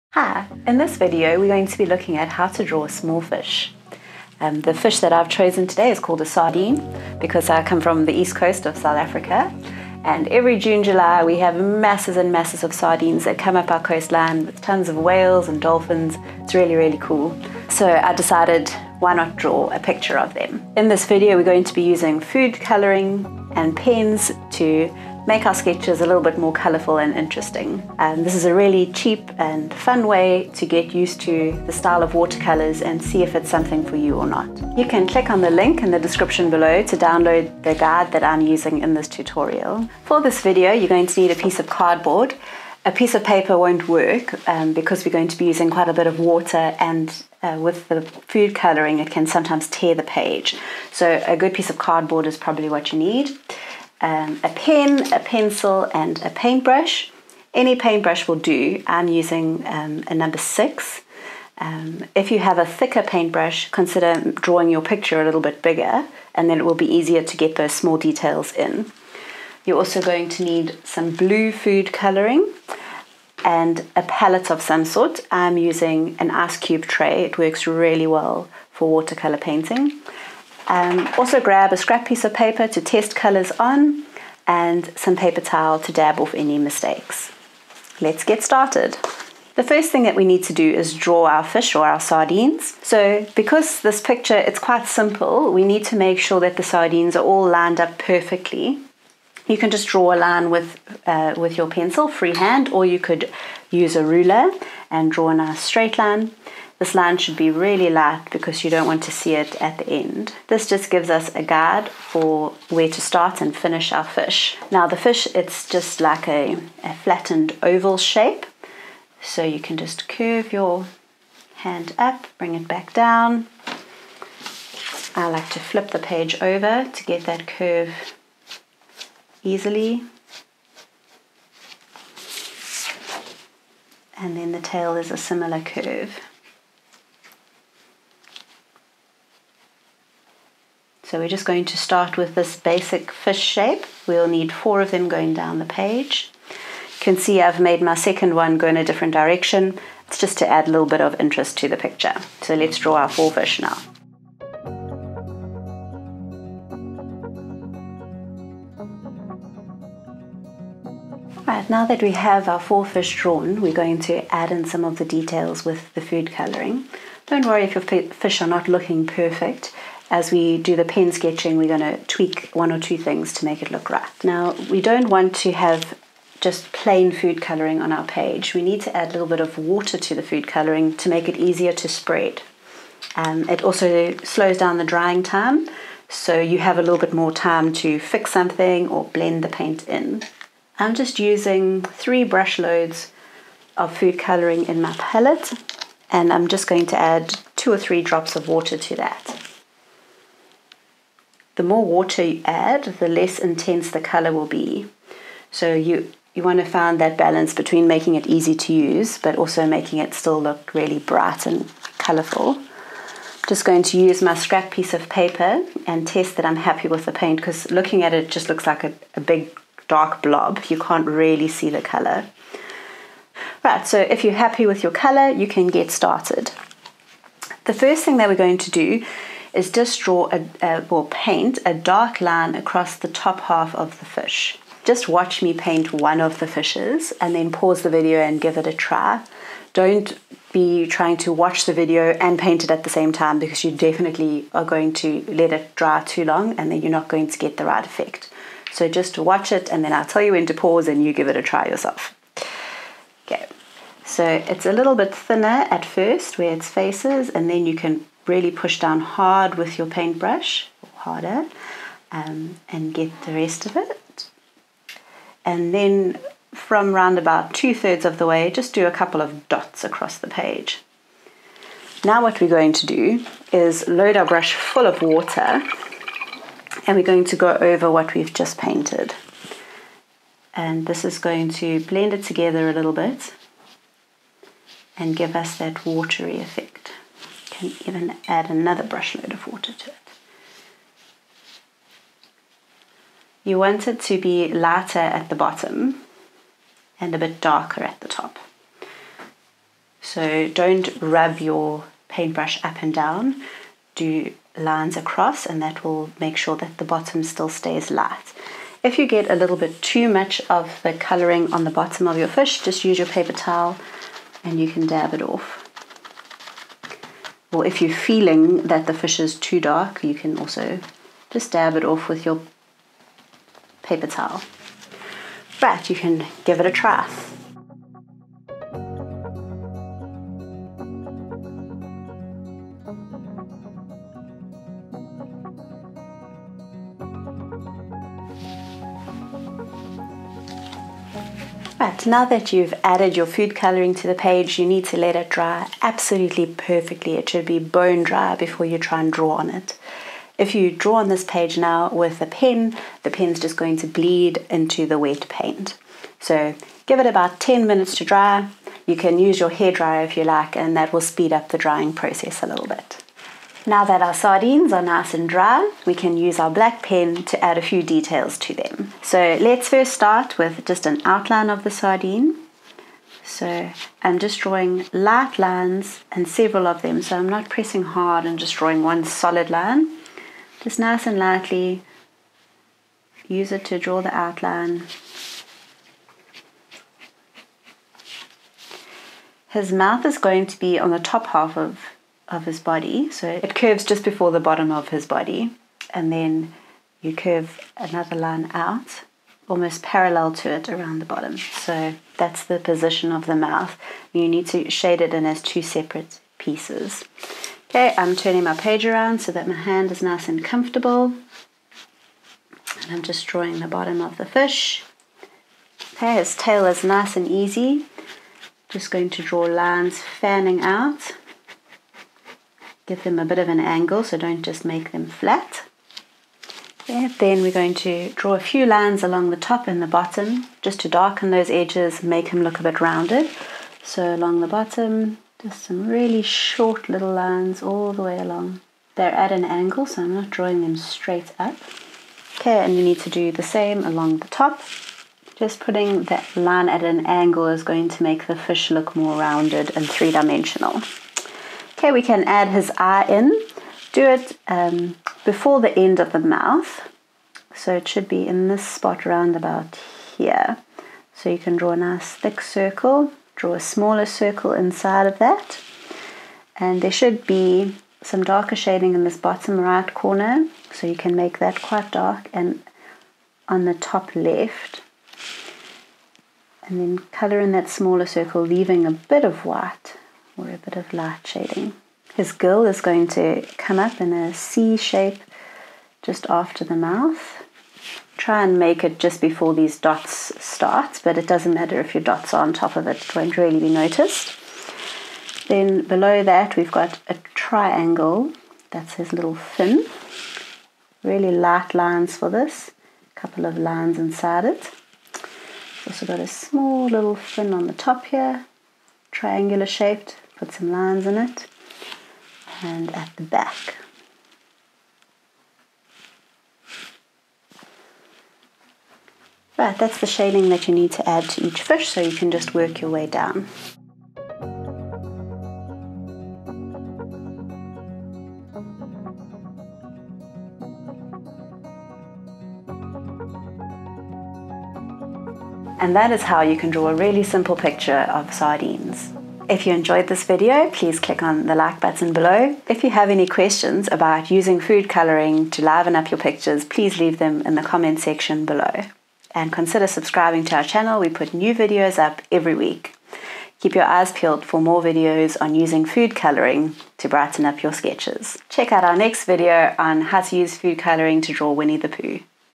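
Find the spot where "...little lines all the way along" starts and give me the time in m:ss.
7:16.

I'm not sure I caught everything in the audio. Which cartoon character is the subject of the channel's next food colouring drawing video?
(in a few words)
Winnie the Pooh.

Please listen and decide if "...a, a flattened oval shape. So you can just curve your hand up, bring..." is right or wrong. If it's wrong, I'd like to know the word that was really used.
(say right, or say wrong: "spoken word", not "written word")
right.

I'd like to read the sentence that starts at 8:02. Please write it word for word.
His gill is going to come up in a C shape just after the mouth.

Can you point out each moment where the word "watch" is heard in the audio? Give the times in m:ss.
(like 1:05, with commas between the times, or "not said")
3:55, 4:01, 4:09.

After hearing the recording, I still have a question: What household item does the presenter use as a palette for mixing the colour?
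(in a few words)
Ice cube tray.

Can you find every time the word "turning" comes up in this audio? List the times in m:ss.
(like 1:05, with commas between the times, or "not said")
6:48.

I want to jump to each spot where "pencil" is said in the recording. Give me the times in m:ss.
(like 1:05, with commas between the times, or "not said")
0:55, 1:41.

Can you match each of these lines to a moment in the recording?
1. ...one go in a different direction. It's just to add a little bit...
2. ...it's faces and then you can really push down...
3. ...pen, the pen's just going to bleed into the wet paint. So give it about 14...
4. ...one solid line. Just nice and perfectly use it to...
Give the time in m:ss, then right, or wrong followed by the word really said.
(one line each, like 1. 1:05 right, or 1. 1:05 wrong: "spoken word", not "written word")
1. 2:28 right
2. 4:16 right
3. 5:52 wrong: "10", not "14"
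4. 6:18 wrong: "lightly", not "perfectly".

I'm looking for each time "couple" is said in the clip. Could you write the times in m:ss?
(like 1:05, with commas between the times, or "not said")
4:28, 8:23.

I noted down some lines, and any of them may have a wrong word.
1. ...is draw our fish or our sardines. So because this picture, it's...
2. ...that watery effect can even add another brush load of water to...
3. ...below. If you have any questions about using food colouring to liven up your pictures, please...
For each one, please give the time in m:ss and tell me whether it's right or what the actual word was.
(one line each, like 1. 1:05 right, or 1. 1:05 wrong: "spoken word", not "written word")
1. 1:30 right
2. 4:45 right
3. 9:02 right.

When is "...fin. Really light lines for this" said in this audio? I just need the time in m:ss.
8:19.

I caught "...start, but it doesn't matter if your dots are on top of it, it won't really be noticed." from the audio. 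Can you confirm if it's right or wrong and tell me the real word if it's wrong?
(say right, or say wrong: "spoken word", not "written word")
right.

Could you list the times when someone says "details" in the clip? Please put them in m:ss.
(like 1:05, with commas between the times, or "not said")
1:07, 2:45, 6:07.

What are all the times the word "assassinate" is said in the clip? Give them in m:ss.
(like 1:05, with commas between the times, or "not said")
not said.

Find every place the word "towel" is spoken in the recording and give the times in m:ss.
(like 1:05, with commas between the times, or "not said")
1:25, 5:13, 5:24.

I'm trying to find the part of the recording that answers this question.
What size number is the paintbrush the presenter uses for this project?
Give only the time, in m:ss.
1:00.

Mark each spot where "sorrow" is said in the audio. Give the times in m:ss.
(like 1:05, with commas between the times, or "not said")
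not said.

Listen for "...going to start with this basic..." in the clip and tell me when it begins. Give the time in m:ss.
2:21.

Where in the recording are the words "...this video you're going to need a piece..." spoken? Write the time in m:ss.
0:40.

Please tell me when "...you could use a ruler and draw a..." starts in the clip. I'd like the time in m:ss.
1:42.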